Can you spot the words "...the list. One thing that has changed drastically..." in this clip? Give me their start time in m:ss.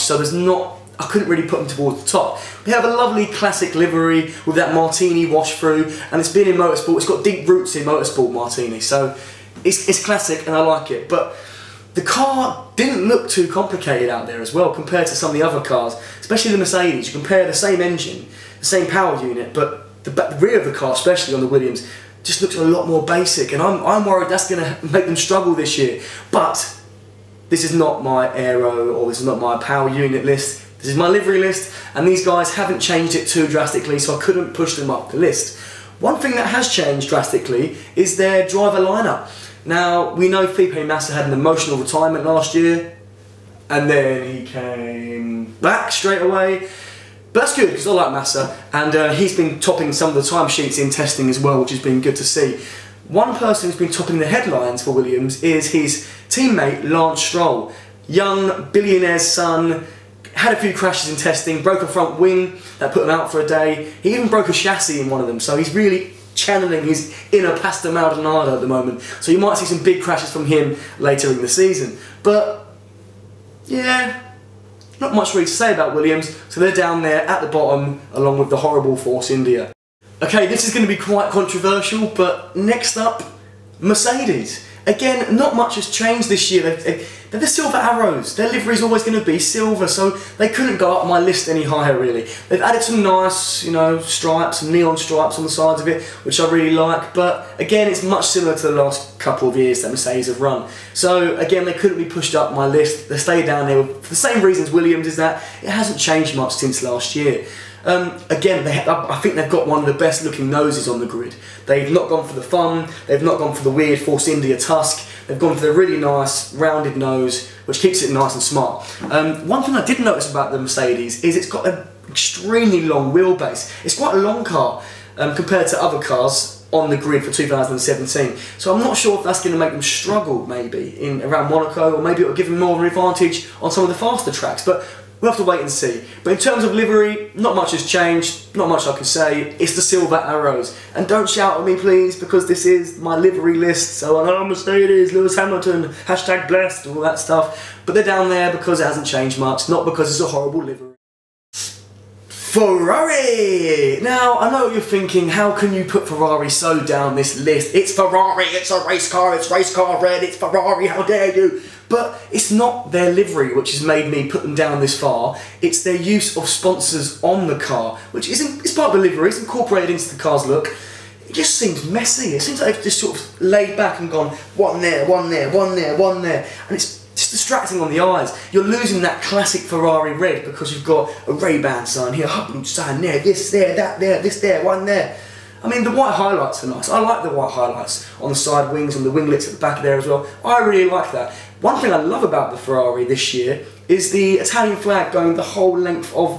0:35.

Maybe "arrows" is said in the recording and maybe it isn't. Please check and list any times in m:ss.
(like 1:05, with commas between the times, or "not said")
1:27, 2:20.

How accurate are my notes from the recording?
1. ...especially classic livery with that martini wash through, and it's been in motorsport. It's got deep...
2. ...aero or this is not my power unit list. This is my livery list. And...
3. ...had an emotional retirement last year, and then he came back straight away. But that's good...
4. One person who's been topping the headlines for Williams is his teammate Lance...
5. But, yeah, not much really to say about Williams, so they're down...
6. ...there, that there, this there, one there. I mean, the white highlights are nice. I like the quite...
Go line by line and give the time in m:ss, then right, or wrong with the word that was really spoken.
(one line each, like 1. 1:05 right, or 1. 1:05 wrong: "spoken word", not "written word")
1. 0:02 wrong: "lovely", not "especially"
2. 0:28 right
3. 0:41 right
4. 0:53 right
5. 1:12 right
6. 3:03 wrong: "white", not "quite".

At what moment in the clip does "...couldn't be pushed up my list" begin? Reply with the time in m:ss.
1:41.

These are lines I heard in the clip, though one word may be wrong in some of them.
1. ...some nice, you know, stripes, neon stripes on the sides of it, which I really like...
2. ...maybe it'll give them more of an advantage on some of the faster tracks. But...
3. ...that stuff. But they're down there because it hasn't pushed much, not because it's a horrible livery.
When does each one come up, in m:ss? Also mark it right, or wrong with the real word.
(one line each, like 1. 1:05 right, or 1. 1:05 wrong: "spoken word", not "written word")
1. 1:32 right
2. 2:12 right
3. 2:26 wrong: "changed", not "pushed".